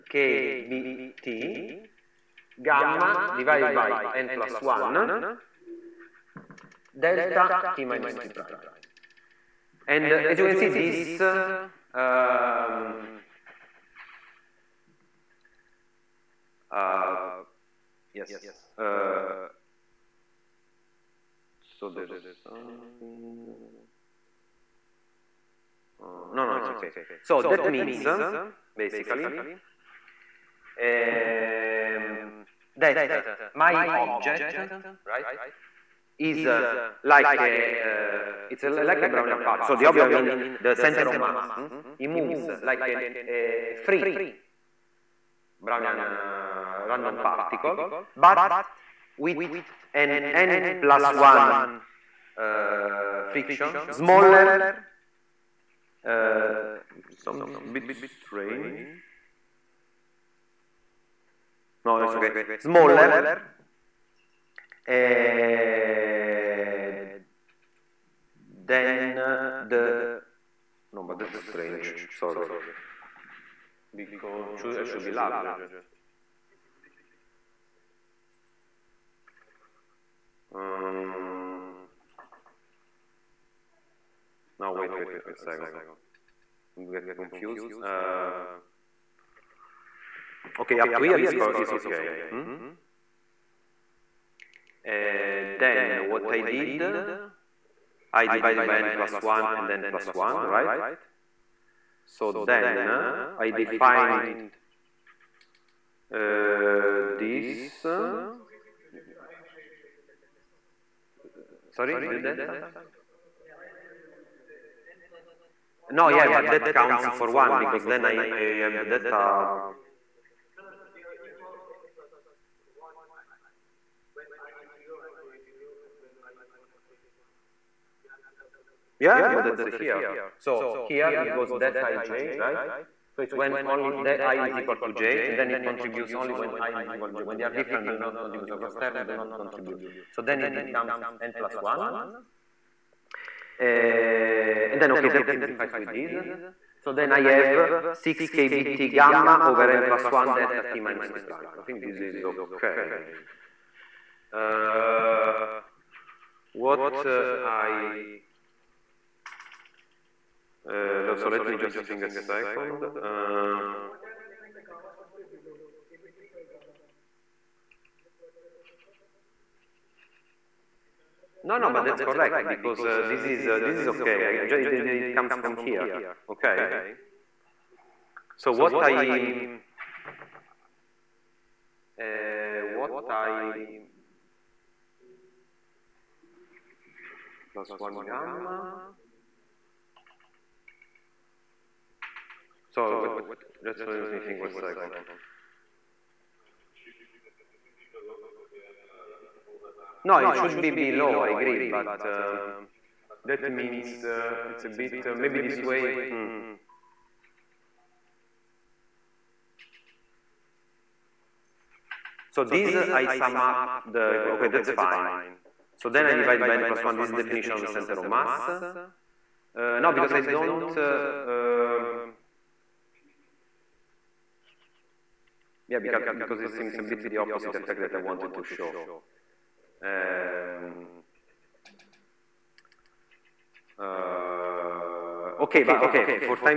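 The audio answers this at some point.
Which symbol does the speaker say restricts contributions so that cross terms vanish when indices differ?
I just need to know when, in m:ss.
2:11.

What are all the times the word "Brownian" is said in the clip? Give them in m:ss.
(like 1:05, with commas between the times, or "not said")
0:39, 0:45.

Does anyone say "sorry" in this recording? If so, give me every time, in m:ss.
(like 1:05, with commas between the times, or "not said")
1:12, 1:51.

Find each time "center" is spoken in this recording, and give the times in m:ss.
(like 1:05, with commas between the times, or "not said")
0:40, 3:37.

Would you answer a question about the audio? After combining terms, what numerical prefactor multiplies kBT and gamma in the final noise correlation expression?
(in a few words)
6.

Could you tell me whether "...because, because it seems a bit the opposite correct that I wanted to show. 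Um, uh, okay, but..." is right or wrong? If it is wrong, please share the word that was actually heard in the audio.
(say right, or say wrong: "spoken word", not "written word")
wrong: "effect", not "correct".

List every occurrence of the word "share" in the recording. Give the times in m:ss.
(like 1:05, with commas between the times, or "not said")
not said.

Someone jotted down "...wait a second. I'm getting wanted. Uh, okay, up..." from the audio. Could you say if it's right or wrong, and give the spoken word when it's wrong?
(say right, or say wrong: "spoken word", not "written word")
wrong: "confused", not "wanted".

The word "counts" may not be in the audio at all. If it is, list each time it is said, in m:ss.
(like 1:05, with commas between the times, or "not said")
1:56.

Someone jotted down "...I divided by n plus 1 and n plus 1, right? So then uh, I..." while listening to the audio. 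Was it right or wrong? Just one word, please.
right.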